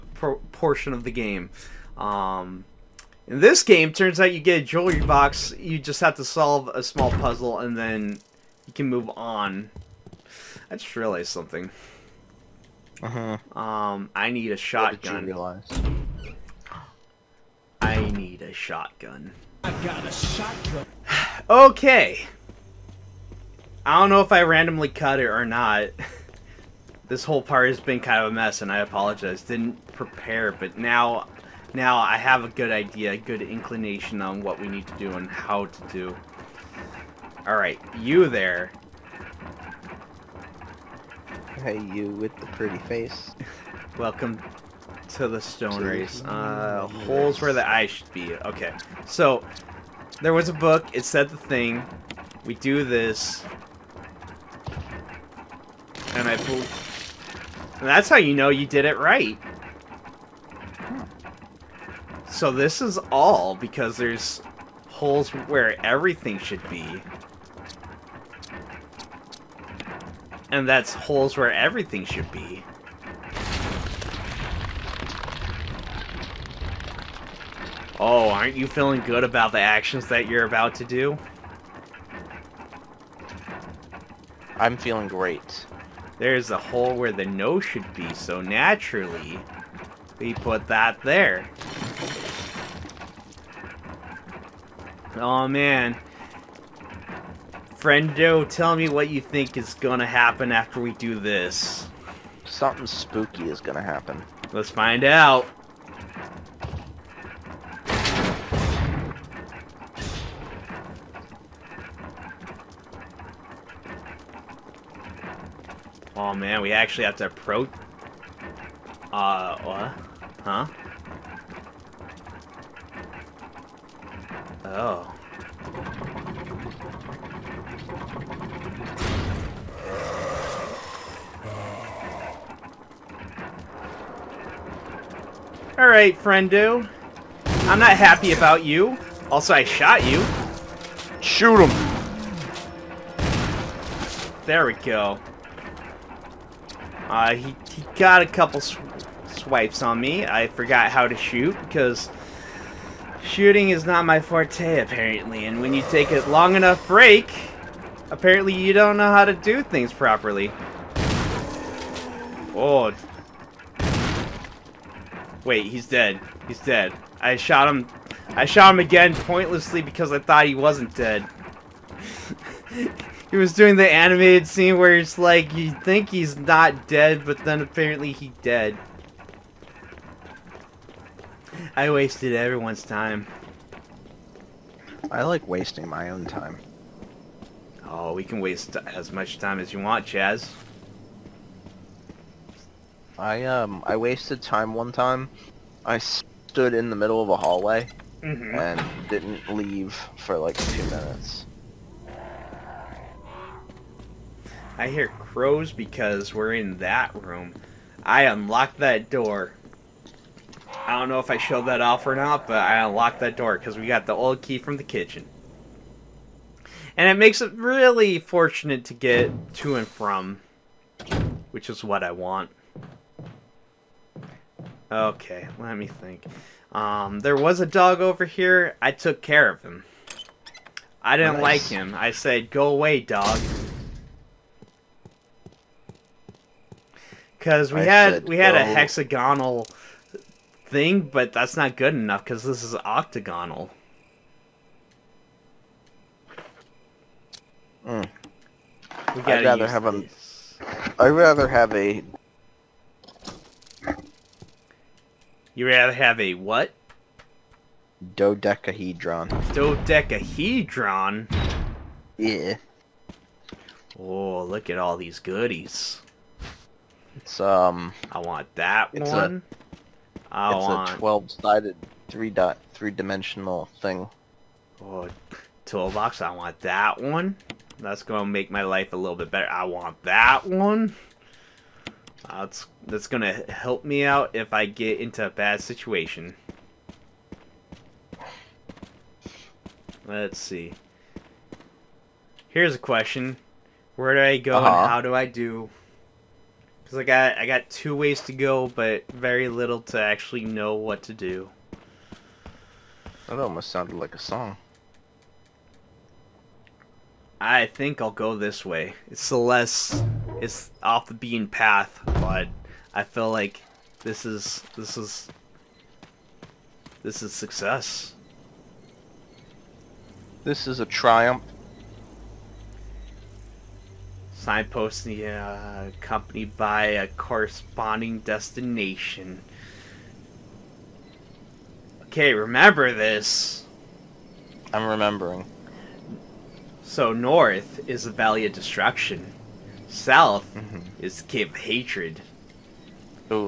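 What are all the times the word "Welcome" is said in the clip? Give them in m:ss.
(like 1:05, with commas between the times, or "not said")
0:43.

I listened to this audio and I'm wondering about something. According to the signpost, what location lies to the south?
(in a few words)
Cave of Hatred.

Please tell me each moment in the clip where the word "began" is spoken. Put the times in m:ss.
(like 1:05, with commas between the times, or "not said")
not said.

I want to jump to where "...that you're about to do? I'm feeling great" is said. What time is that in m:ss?
1:20.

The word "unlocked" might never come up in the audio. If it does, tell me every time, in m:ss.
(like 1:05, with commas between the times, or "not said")
3:28, 3:32.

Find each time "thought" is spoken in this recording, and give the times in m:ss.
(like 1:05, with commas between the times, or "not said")
2:50.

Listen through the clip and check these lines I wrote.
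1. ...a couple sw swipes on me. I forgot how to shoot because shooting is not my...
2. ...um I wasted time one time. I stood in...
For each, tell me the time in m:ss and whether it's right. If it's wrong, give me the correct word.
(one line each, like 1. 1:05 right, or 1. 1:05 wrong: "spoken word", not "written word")
1. 2:28 right
2. 3:13 right.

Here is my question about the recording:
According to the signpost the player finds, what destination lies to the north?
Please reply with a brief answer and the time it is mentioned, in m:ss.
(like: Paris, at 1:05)
Valley of Destruction, at 5:38.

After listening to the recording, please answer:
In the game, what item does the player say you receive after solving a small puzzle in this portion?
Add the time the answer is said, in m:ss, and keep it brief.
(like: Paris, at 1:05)
Jewelry box, at 0:04.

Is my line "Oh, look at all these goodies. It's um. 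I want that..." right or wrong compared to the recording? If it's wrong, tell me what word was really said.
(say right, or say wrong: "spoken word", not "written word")
right.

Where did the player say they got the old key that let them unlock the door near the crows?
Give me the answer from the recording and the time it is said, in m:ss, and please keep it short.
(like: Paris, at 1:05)
The kitchen, at 3:34.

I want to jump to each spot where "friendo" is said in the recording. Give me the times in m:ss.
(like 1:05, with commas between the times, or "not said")
1:37, 2:16.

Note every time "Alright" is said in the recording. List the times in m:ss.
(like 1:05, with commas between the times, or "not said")
0:37, 2:15.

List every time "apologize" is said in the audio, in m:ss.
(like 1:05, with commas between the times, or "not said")
0:28.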